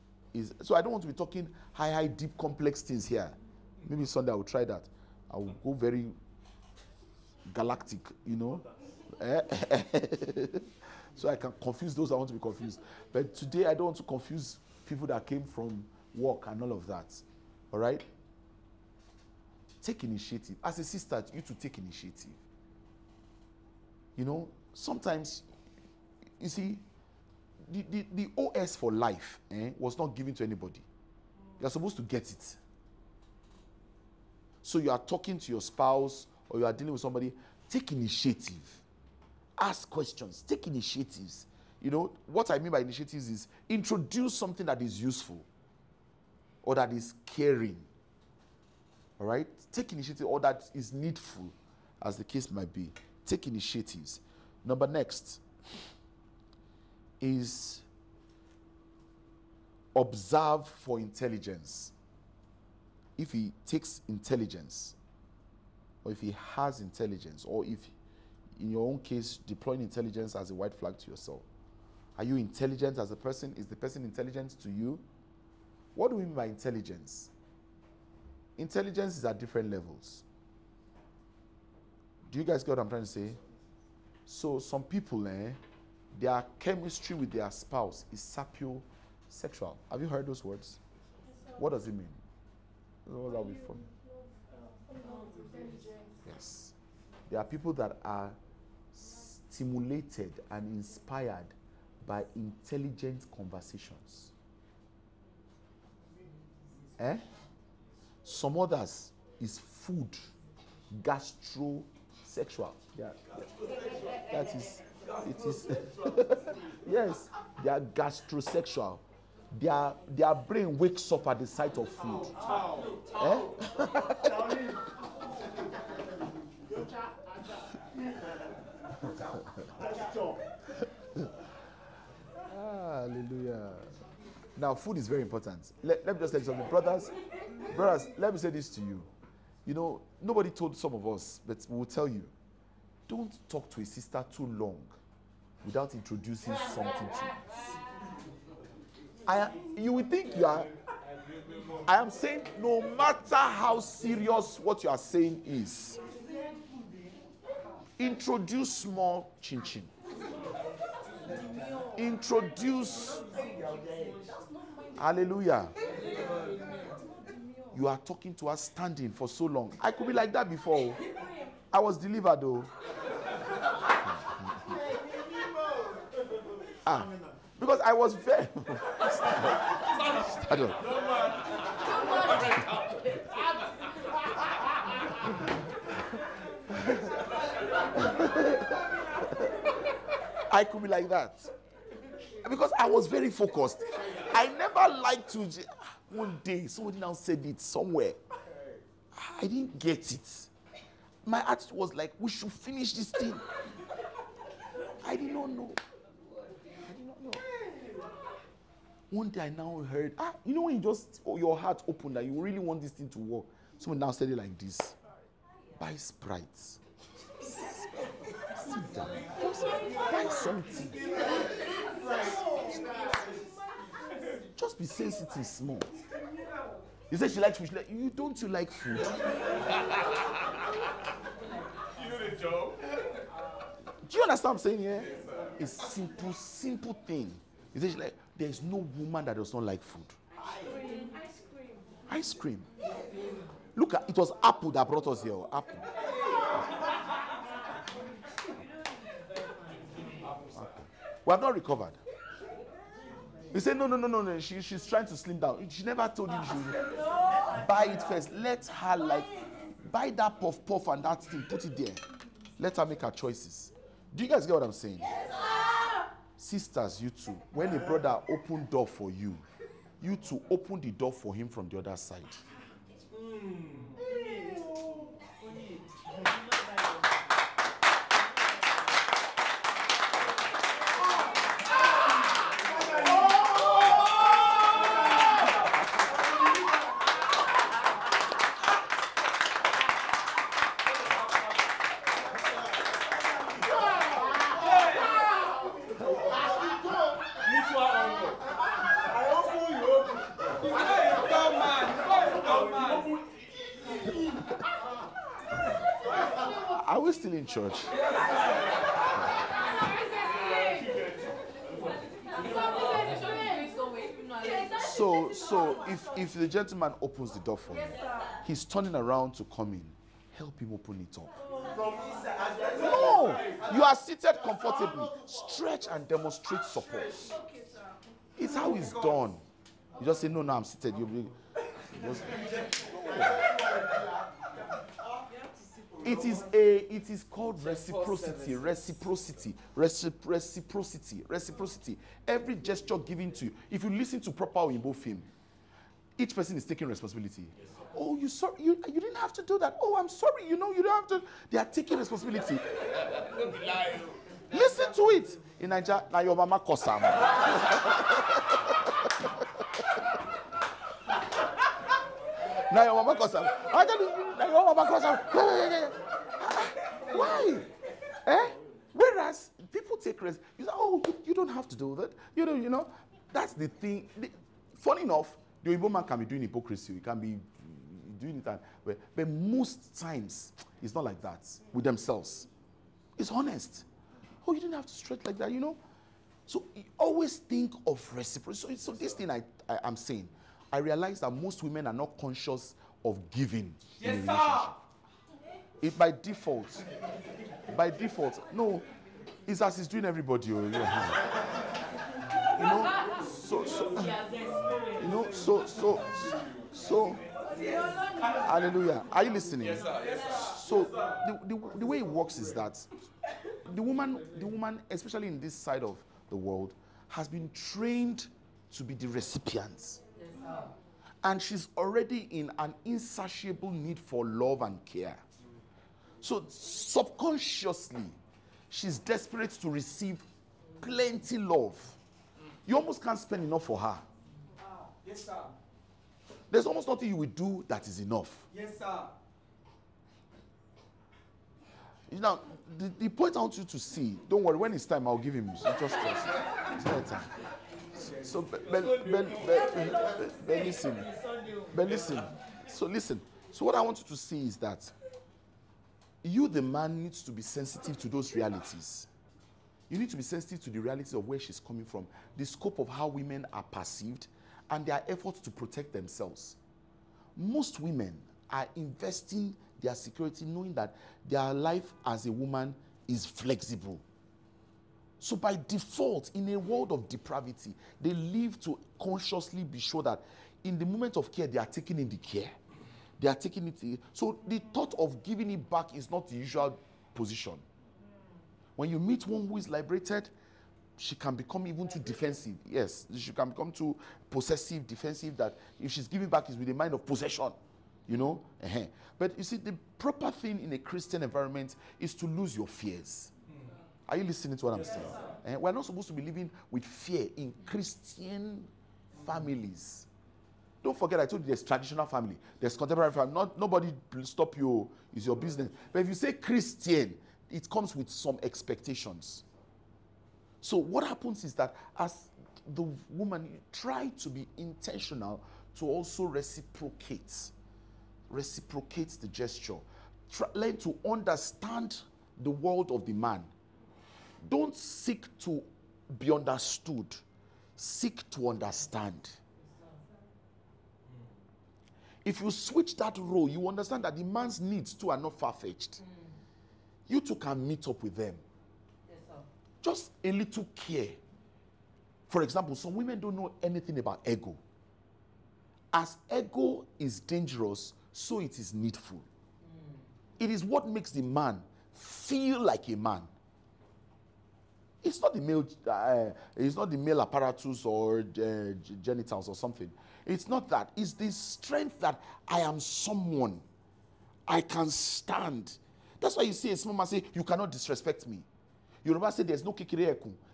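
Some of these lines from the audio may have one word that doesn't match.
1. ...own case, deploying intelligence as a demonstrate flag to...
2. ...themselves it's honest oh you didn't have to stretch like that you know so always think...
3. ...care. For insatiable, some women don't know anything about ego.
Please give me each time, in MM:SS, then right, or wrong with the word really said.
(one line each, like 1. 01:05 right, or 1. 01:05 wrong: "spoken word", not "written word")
1. 01:08 wrong: "white", not "demonstrate"
2. 06:21 right
3. 09:10 wrong: "example", not "insatiable".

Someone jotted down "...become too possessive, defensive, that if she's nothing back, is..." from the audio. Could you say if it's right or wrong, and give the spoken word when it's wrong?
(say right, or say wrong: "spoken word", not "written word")
wrong: "giving", not "nothing".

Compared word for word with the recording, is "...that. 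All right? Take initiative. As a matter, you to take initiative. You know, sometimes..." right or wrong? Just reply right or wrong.
wrong.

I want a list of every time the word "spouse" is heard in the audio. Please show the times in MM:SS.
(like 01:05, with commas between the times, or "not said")
00:35, 01:27.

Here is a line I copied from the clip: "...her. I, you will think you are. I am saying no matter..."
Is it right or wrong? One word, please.
right.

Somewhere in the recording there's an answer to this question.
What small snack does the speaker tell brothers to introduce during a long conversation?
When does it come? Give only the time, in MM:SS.
02:39.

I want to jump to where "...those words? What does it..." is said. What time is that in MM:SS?
01:30.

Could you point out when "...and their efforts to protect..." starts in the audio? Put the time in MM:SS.
07:44.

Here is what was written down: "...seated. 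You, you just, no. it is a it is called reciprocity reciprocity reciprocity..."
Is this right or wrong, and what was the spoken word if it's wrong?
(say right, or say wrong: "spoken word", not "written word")
right.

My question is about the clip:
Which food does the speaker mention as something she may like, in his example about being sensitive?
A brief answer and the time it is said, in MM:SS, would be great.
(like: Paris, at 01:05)
Fish, at 03:47.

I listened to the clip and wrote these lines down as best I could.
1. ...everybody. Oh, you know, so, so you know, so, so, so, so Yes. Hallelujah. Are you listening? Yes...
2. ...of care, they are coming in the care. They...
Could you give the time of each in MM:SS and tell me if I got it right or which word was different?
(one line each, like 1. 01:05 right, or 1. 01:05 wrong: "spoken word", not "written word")
1. 06:40 right
2. 08:01 wrong: "taking", not "coming".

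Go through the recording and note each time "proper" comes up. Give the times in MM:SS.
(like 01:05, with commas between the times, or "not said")
05:44, 08:19.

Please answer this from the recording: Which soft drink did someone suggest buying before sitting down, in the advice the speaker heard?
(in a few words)
Sprite.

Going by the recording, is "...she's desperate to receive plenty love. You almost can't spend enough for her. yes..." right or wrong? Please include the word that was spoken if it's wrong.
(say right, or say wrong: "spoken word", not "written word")
right.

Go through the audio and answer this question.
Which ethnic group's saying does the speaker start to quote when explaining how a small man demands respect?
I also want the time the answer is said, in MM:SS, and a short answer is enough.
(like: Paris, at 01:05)
Yoruba, at 09:39.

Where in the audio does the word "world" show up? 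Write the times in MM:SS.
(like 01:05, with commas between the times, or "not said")
06:56, 07:56, 08:52.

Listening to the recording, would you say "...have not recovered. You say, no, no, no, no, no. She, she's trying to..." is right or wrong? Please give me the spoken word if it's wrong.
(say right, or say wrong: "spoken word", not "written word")
right.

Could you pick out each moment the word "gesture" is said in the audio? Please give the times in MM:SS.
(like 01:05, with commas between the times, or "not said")
05:42, 08:49.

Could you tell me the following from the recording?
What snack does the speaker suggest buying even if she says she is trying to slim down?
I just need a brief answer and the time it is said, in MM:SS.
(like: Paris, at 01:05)
Puff puff, at 04:20.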